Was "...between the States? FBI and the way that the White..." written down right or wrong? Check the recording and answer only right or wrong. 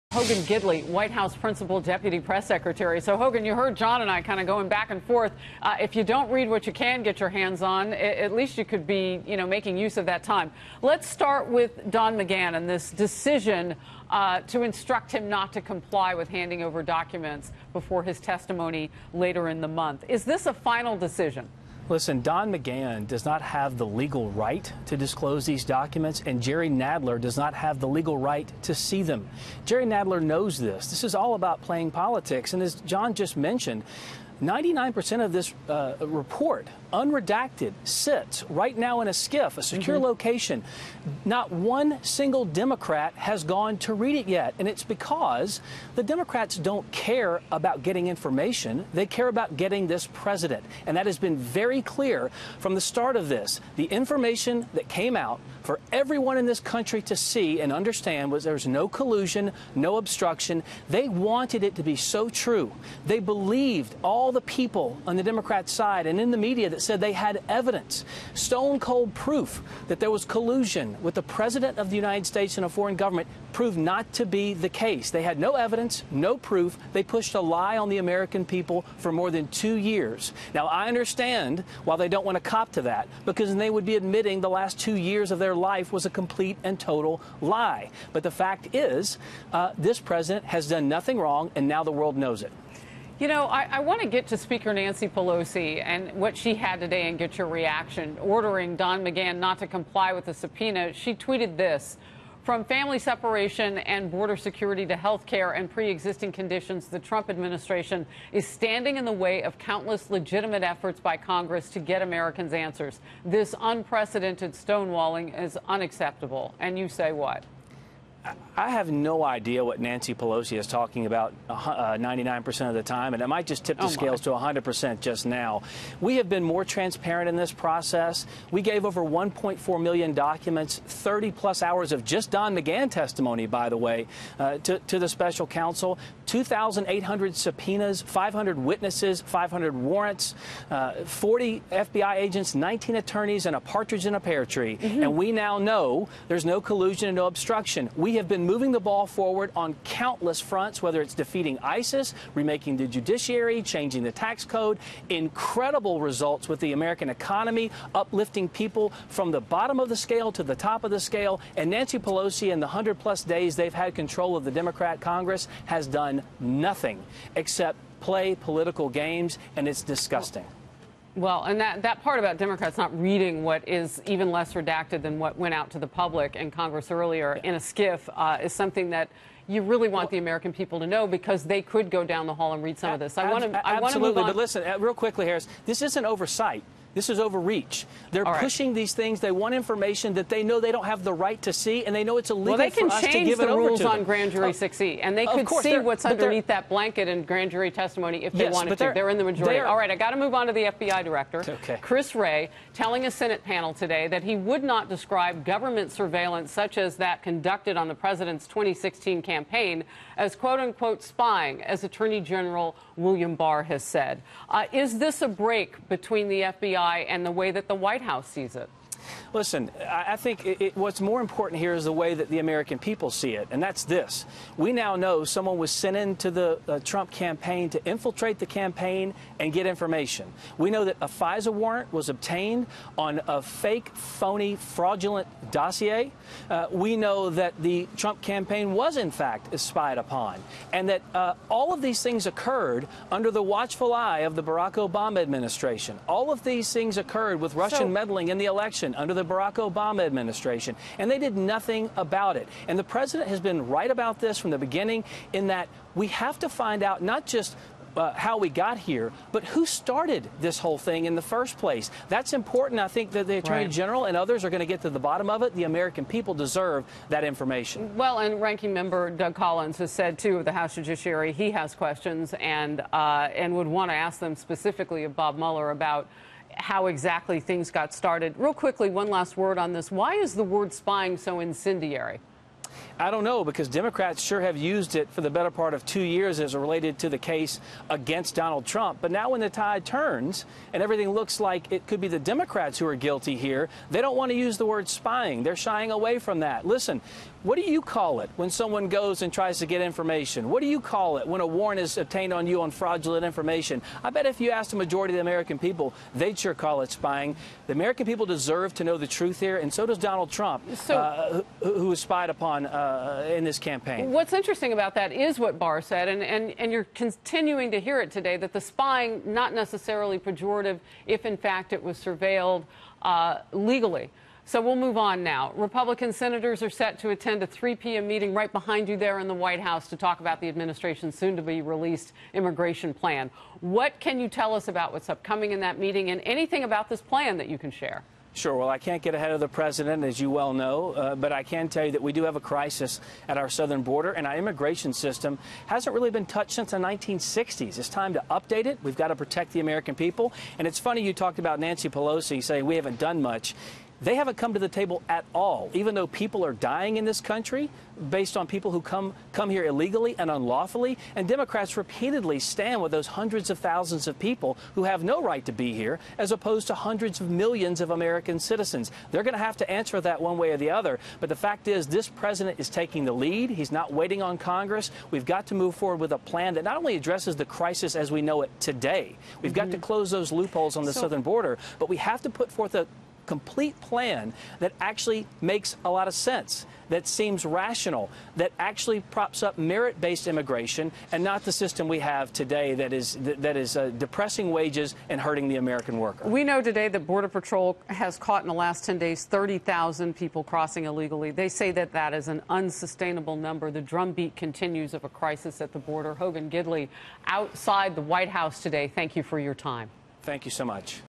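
wrong.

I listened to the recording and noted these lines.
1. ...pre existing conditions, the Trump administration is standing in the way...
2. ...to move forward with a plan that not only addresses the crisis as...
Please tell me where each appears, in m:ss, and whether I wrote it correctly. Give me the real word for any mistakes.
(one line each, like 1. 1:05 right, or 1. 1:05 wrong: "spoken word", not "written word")
1. 1:45 right
2. 6:15 right.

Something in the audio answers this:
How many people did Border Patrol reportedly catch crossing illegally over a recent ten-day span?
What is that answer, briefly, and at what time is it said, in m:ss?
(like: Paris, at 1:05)
30,000, at 6:39.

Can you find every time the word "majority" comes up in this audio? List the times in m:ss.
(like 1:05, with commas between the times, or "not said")
3:19, 5:04.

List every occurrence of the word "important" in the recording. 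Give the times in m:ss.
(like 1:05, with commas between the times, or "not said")
3:41, 4:22.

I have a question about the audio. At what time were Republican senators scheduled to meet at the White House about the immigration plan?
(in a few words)
3 p.m.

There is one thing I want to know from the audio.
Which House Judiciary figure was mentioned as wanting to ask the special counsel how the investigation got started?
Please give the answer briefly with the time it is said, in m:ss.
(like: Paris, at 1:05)
Doug Collins, at 4:29.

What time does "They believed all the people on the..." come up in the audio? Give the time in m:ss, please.
1:03.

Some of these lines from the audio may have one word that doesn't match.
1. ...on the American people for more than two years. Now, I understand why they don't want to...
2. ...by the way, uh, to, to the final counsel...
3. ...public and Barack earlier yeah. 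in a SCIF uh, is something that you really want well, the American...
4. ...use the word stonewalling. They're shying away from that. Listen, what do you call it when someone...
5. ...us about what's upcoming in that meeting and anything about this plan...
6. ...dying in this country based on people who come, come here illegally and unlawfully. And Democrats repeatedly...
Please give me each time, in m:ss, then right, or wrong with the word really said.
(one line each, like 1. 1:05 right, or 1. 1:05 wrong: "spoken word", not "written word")
1. 1:17 right
2. 2:13 wrong: "special", not "final"
3. 2:55 wrong: "Congress", not "Barack"
4. 4:54 wrong: "spying", not "stonewalling"
5. 5:34 right
6. 5:56 right.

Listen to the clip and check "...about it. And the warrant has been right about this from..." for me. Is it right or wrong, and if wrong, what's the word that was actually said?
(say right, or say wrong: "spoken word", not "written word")
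wrong: "president", not "warrant".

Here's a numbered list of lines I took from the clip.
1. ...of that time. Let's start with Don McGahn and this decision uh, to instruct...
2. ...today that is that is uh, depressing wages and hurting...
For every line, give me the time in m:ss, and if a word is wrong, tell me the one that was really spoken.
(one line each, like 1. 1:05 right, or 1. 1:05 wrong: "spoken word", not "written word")
1. 0:09 right
2. 6:32 right.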